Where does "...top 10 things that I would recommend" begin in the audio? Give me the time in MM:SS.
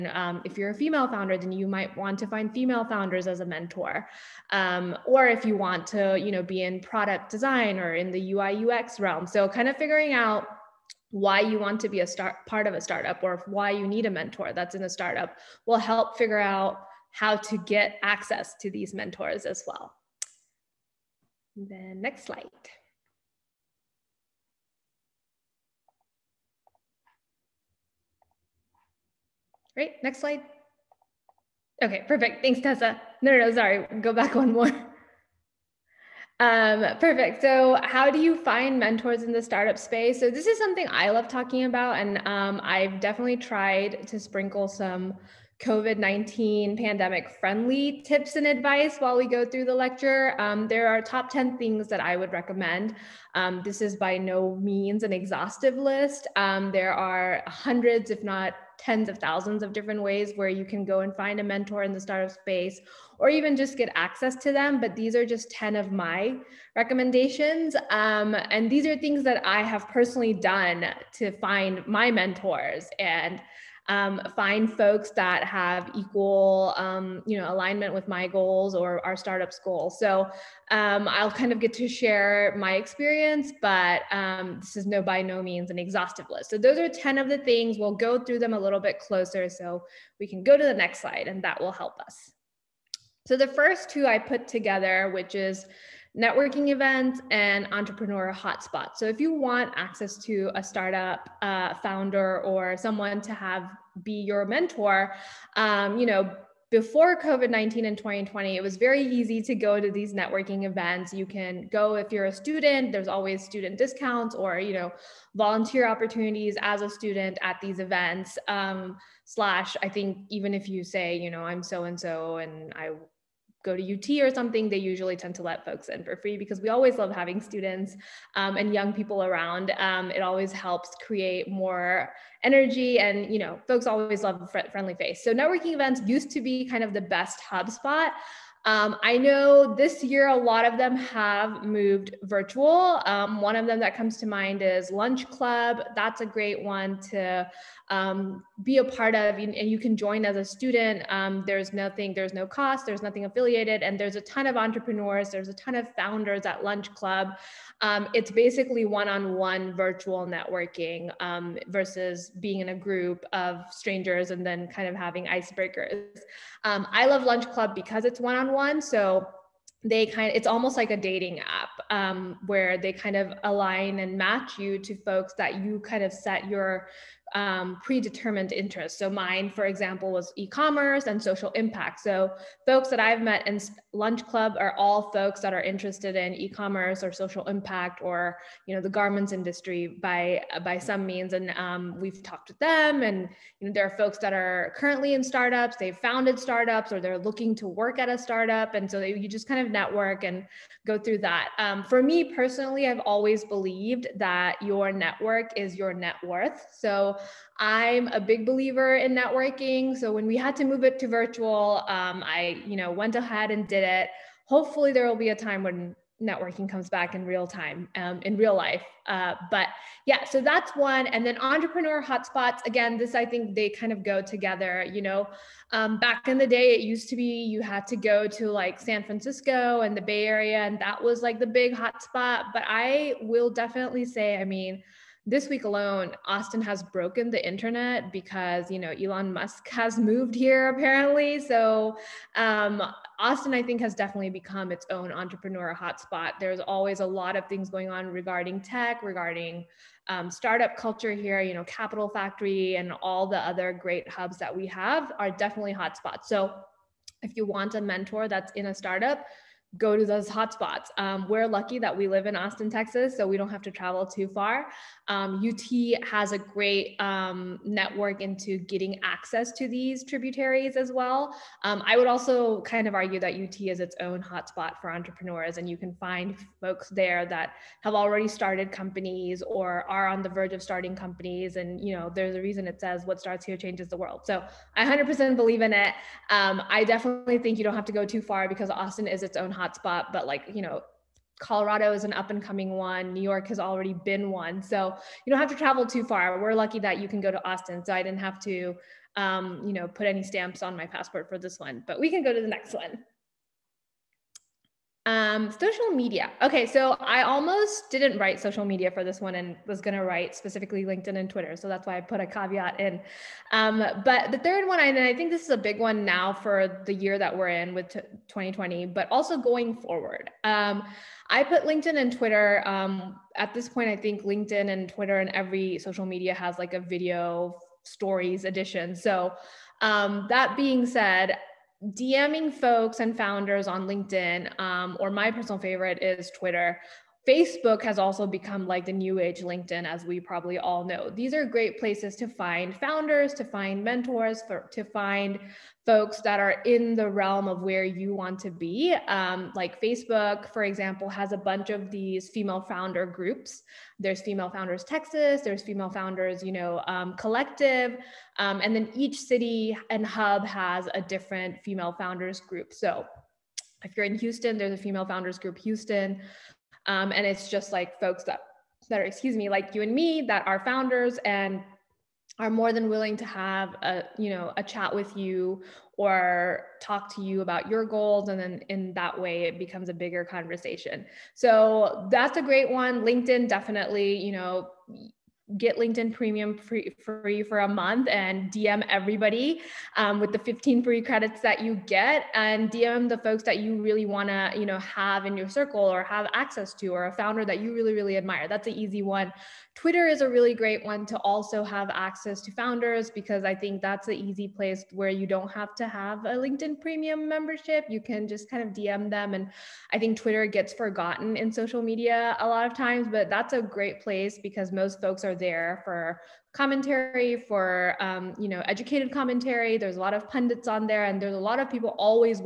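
00:51.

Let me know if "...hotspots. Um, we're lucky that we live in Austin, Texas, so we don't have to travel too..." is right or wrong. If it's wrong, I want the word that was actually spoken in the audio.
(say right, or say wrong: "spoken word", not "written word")
right.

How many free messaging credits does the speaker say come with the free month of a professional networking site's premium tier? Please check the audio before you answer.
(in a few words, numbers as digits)
15.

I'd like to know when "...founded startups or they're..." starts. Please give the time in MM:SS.
03:15.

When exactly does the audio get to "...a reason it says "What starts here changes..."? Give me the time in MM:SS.
04:42.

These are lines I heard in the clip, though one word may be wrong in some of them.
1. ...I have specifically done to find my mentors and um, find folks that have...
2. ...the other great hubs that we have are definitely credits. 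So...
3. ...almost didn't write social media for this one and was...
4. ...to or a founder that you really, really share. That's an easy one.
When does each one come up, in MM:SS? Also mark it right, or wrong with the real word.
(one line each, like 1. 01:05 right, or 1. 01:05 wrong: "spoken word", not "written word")
1. 01:09 wrong: "personally", not "specifically"
2. 04:13 wrong: "hotspots", not "credits"
3. 05:07 right
4. 06:36 wrong: "admire", not "share".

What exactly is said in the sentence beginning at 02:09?
Um, it always helps create more energy and, you know, folks always love a friendly face.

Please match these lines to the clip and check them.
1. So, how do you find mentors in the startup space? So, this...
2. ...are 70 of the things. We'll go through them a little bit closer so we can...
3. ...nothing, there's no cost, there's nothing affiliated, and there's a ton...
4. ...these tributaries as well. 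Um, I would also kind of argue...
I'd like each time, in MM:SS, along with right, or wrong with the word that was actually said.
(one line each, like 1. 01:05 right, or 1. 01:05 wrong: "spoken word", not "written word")
1. 00:37 right
2. 01:26 wrong: "10", not "70"
3. 02:31 right
4. 04:29 right.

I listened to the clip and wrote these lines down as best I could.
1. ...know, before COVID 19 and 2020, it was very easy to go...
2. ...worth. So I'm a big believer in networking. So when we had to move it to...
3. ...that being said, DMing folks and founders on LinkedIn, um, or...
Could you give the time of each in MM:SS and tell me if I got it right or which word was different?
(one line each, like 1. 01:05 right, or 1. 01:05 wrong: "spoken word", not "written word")
1. 01:46 right
2. 03:26 right
3. 05:30 right.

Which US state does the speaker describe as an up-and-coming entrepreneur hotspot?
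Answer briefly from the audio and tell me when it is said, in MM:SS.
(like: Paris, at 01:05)
Colorado, at 04:51.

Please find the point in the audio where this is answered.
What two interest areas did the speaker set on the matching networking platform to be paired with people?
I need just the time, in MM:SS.
03:00.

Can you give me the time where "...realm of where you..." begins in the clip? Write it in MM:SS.
05:47.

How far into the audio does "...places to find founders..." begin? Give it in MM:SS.
05:41.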